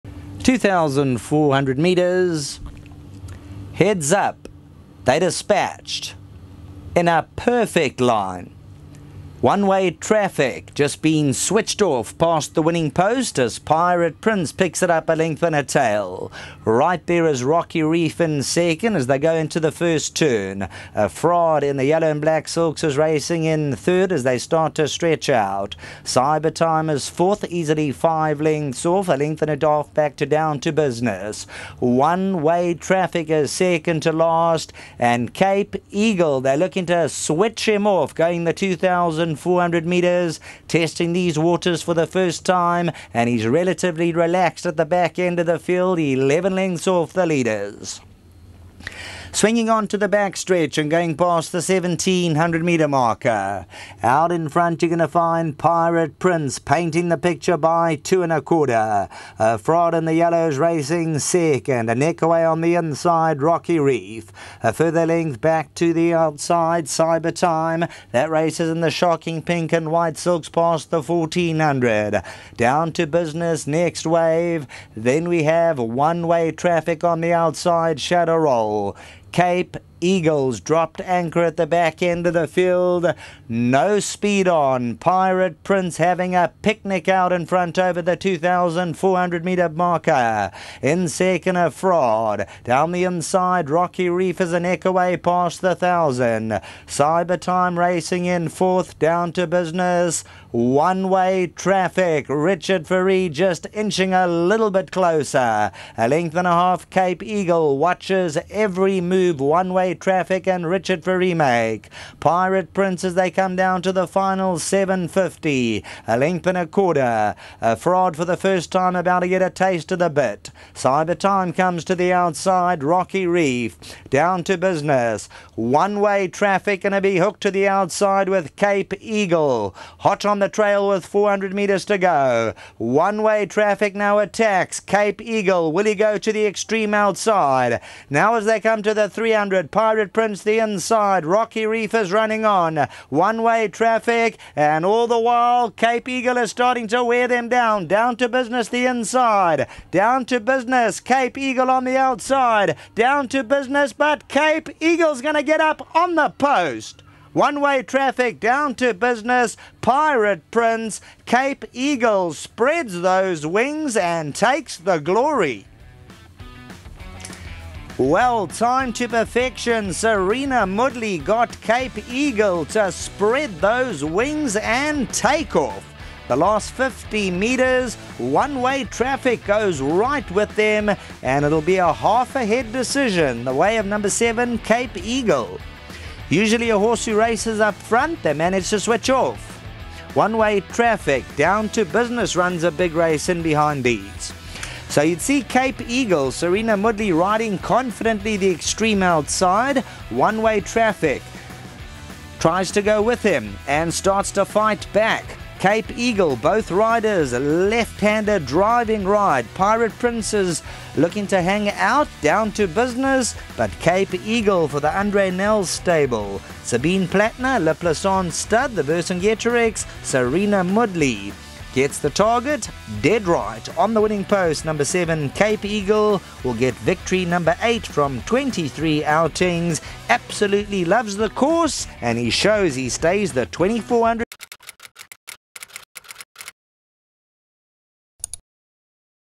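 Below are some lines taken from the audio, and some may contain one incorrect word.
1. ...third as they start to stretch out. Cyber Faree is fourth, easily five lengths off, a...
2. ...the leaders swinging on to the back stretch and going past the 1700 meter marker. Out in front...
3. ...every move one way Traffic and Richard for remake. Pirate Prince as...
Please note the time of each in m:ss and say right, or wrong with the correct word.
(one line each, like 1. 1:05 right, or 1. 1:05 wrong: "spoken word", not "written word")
1. 0:23 wrong: "Time", not "Faree"
2. 0:47 right
3. 1:48 right.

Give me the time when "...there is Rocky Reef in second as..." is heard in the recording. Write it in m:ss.
0:17.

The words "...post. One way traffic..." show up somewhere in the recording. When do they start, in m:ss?
2:36.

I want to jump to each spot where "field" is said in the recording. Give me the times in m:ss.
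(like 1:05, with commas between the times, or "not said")
0:45, 1:22.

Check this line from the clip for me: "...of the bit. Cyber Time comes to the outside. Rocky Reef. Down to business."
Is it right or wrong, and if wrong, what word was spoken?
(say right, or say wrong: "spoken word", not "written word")
right.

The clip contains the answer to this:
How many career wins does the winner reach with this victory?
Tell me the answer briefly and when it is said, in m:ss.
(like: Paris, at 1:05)
8, at 3:46.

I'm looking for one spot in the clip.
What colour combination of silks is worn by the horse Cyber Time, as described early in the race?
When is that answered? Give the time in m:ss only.
1:08.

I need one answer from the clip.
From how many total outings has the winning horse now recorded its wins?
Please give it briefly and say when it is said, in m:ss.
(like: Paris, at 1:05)
23, at 3:48.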